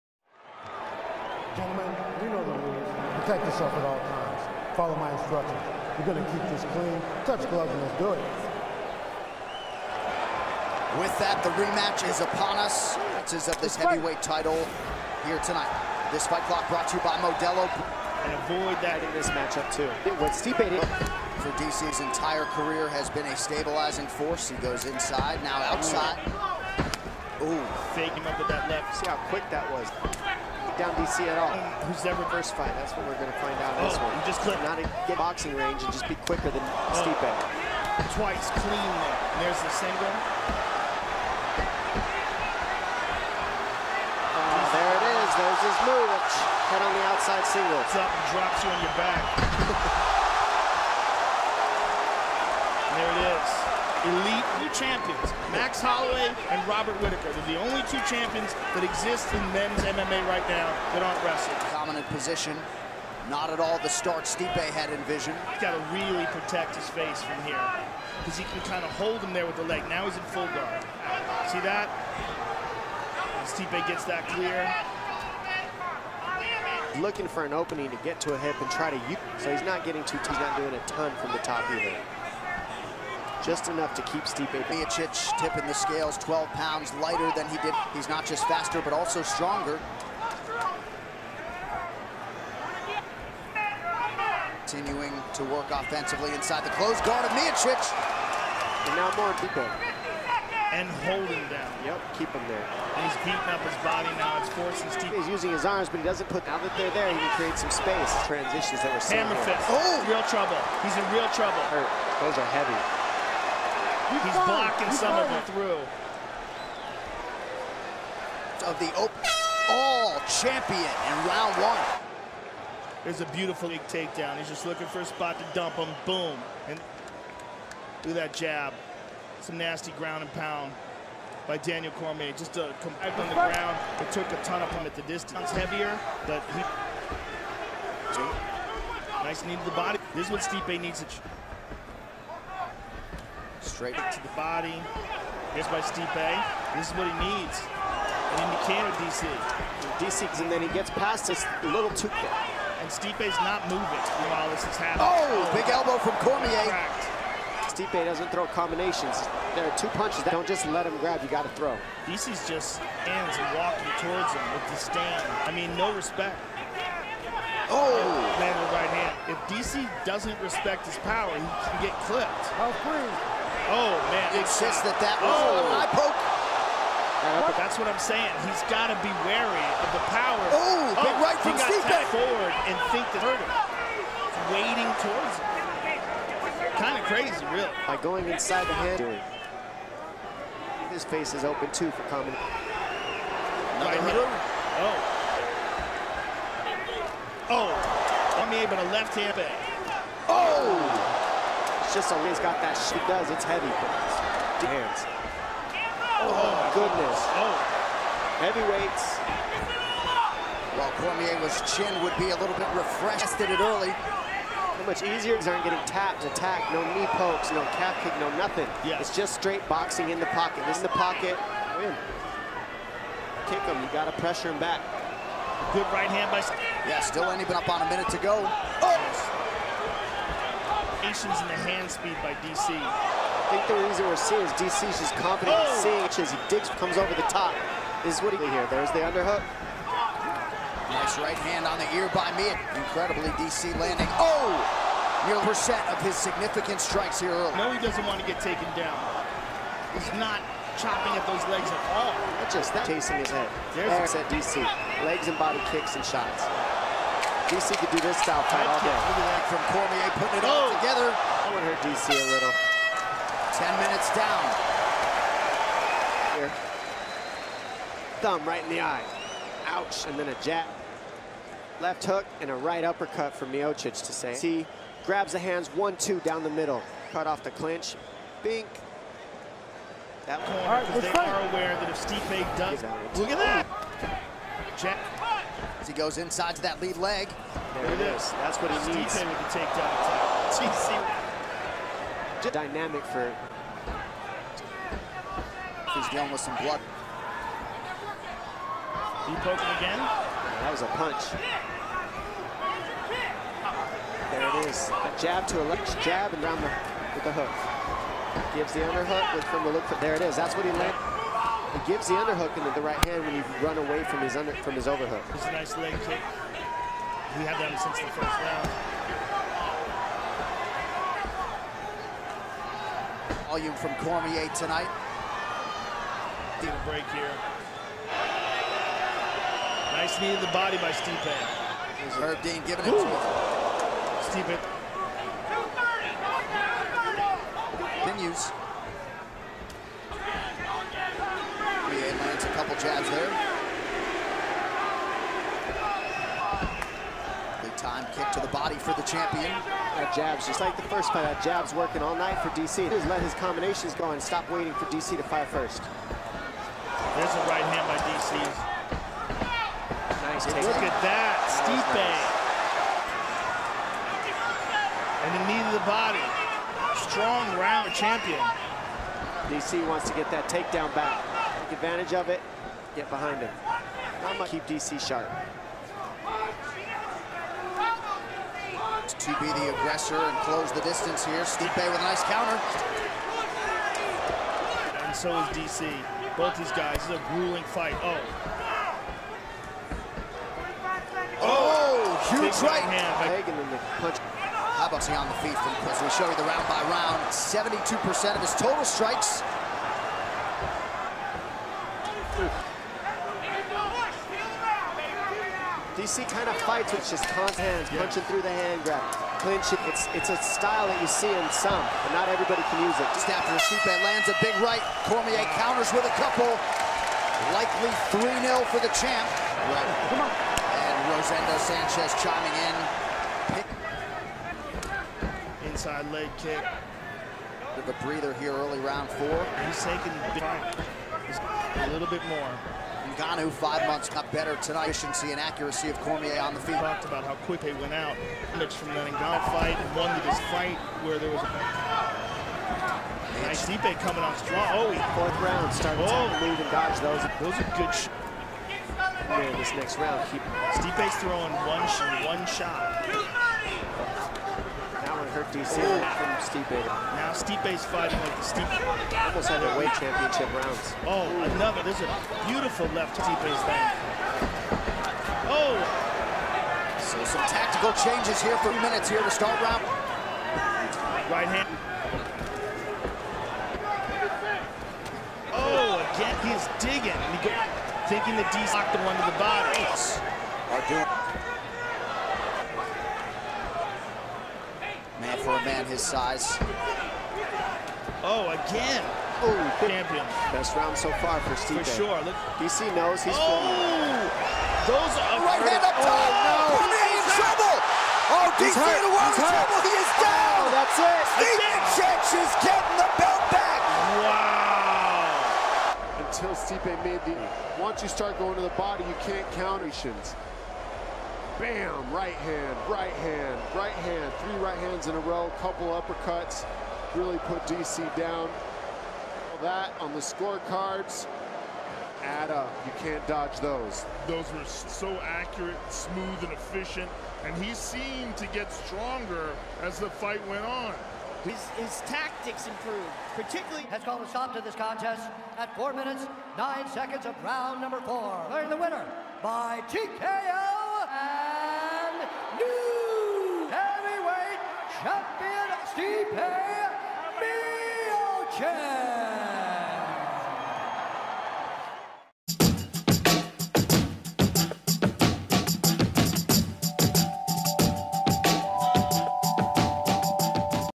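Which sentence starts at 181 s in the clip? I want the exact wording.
He forward and think that hurt him.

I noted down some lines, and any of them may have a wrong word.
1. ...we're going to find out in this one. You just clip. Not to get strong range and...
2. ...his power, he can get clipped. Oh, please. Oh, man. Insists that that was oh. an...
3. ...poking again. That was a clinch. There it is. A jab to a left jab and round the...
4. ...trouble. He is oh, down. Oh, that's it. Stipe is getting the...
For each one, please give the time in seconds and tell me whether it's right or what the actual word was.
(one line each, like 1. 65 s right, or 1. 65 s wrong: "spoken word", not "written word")
1. 33 s wrong: "boxing", not "strong"
2. 170 s right
3. 299 s wrong: "punch", not "clinch"
4. 499 s right.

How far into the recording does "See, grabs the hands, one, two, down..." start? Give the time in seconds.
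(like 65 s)
274 s.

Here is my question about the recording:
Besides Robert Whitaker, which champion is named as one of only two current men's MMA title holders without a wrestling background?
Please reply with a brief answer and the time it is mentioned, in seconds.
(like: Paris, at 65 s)
Max Holloway, at 55 s.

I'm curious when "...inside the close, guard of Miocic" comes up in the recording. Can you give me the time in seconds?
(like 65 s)
96 s.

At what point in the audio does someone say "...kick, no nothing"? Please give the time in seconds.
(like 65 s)
218 s.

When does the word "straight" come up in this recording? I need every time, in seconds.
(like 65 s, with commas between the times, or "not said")
143 s, 219 s.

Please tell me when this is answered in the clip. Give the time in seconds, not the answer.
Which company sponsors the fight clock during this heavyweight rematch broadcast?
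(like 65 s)
17 s.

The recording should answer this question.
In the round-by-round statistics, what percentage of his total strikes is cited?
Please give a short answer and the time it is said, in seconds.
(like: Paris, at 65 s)
72%, at 397 s.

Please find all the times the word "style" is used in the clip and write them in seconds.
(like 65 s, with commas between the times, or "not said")
258 s, 410 s.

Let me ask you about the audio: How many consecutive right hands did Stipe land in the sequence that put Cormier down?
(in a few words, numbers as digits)
3.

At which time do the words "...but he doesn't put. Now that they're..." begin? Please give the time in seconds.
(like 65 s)
105 s.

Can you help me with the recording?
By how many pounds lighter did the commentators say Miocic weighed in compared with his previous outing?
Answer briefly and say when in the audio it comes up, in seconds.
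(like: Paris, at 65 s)
12, at 86 s.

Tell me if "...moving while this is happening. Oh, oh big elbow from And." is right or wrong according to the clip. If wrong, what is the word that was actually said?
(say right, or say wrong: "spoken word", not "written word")
wrong: "Cormier", not "And".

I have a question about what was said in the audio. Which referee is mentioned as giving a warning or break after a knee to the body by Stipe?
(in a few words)
Herb Dean.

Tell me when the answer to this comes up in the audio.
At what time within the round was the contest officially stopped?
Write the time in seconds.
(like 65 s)
535 s.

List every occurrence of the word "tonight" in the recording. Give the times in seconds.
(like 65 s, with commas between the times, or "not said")
15 s, 324 s, 434 s.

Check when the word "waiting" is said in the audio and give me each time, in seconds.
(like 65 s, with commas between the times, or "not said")
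184 s, 354 s.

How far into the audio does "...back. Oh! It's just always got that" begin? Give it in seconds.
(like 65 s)
199 s.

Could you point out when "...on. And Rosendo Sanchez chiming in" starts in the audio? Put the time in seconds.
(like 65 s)
420 s.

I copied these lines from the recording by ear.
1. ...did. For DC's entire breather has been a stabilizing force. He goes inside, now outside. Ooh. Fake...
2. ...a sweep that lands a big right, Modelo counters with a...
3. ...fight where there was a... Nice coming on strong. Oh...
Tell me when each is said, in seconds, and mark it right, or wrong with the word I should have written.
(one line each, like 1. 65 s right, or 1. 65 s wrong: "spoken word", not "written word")
1. 20 s wrong: "career", not "breather"
2. 413 s wrong: "Cormier", not "Modelo"
3. 440 s right.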